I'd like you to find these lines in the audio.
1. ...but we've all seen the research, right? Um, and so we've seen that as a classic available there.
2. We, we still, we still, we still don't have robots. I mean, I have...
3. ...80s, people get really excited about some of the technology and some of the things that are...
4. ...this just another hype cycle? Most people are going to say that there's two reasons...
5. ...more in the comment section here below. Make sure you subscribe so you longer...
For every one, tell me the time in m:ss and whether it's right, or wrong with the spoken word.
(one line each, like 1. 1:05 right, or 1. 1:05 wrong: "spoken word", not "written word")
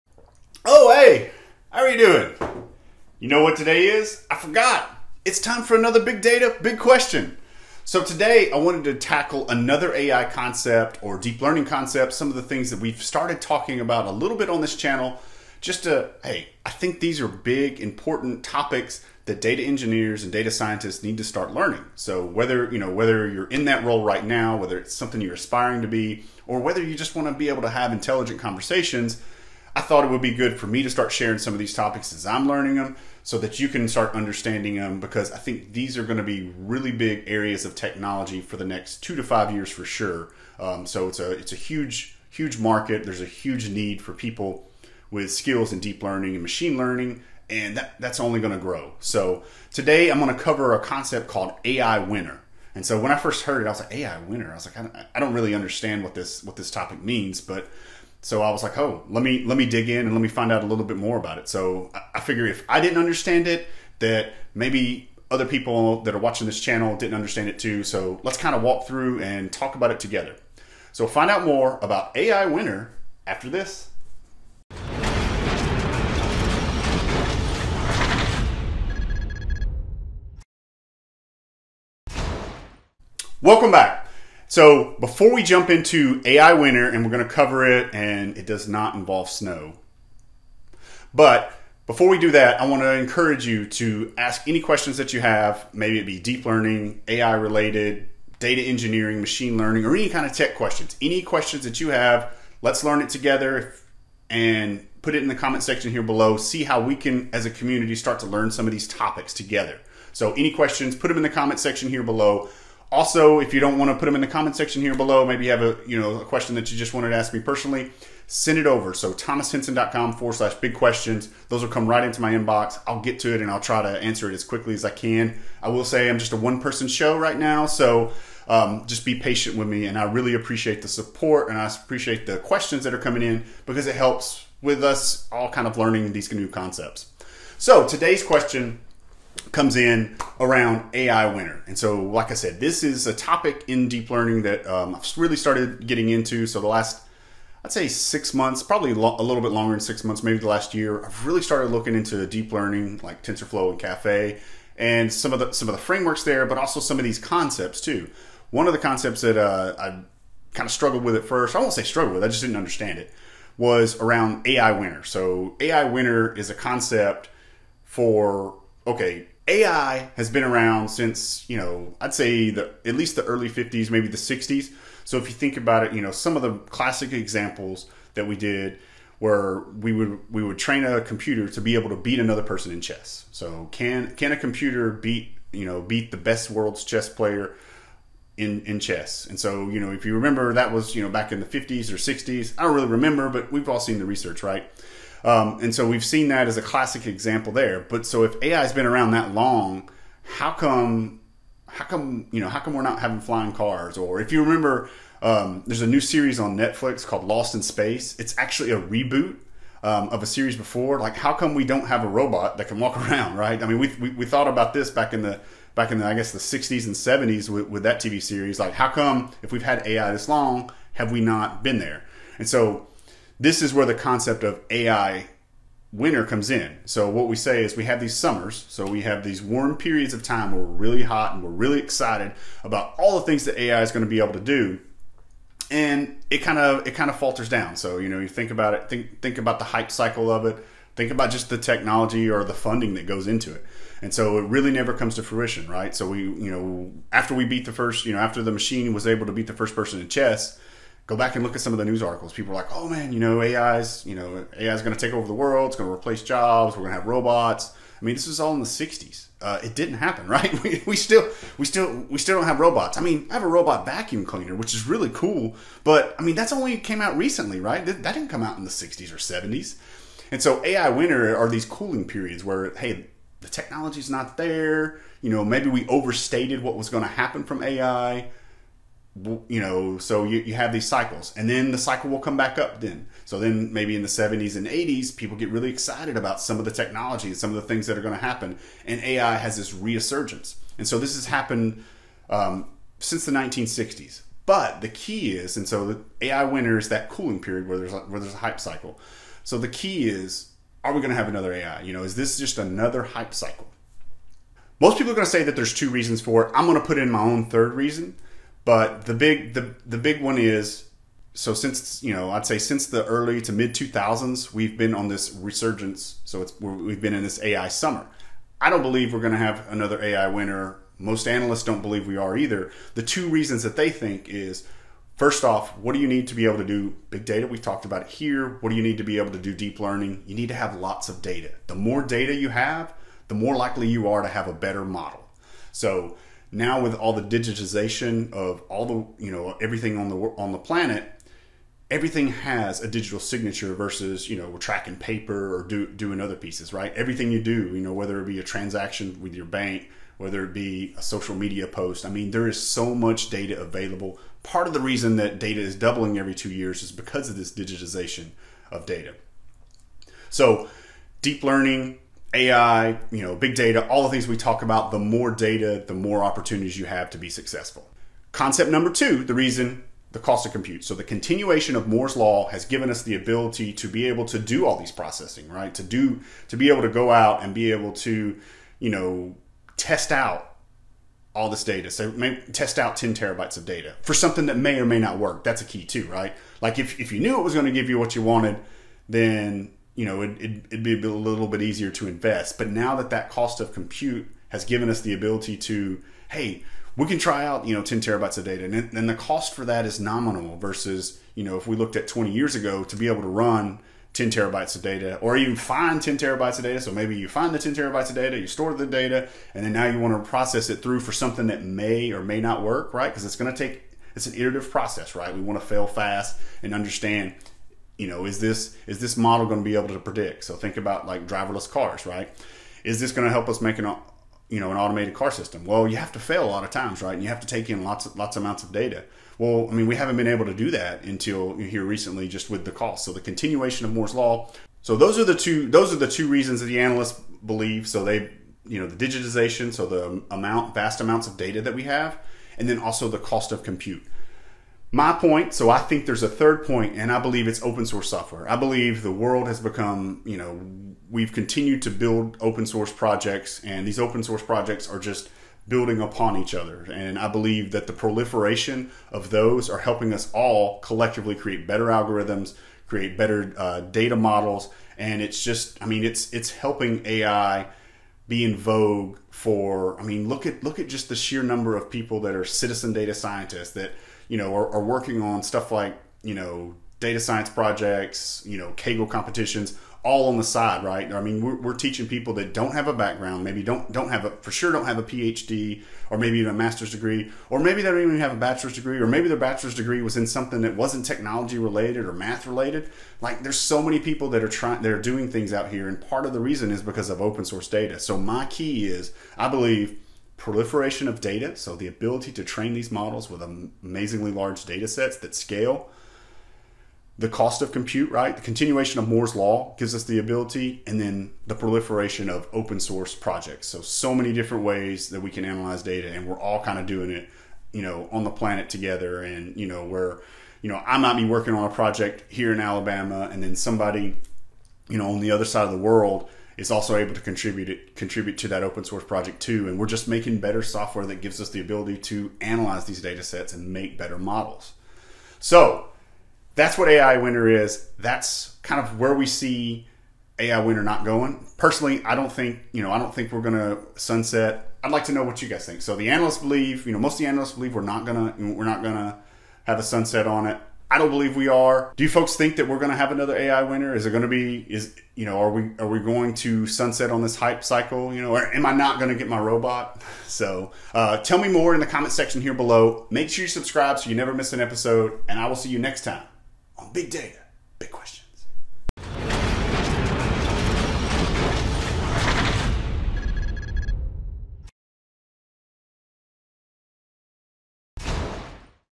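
1. 3:13 wrong: "example", not "available"
2. 4:20 right
3. 4:44 right
4. 5:02 right
5. 9:21 wrong: "never", not "longer".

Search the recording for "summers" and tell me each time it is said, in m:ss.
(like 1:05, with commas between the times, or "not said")
3:48, 5:17.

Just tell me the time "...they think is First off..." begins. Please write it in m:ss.
5:23.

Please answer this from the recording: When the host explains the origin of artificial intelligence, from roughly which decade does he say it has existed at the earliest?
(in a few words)
early 50s.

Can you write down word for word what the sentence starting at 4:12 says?
People are like, "Oh man, you know, AI's, you know, AI's going to take over the world.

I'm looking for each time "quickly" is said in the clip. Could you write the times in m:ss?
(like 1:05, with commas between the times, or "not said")
2:04.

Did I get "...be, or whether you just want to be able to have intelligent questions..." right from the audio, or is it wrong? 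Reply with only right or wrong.
wrong.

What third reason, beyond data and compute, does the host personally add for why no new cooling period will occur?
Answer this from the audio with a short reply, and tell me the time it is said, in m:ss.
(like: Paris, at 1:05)
open source software, at 7:27.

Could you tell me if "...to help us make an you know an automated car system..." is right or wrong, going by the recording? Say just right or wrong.
right.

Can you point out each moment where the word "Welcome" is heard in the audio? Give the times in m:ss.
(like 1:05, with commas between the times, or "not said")
1:23.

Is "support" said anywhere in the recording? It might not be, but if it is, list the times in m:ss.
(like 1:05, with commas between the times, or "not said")
2:10.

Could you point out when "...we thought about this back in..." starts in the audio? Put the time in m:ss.
3:34.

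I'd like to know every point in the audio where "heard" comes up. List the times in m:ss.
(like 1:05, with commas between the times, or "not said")
0:53.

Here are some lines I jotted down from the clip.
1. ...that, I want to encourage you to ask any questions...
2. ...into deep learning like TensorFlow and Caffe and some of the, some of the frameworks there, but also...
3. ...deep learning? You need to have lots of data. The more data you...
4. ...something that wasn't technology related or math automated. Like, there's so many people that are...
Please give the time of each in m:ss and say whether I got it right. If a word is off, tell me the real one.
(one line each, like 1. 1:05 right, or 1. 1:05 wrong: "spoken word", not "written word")
1. 1:32 right
2. 2:31 right
3. 5:29 right
4. 8:10 wrong: "related", not "automated".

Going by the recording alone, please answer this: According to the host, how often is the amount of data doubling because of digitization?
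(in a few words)
every 2 years.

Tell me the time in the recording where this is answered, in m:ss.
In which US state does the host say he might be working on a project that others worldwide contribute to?
8:42.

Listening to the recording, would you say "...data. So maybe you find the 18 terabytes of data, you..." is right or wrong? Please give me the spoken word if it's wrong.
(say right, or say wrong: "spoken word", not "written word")
wrong: "10", not "18".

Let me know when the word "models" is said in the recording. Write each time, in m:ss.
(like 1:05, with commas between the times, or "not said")
5:34, 6:59, 7:44, 8:22, 8:54.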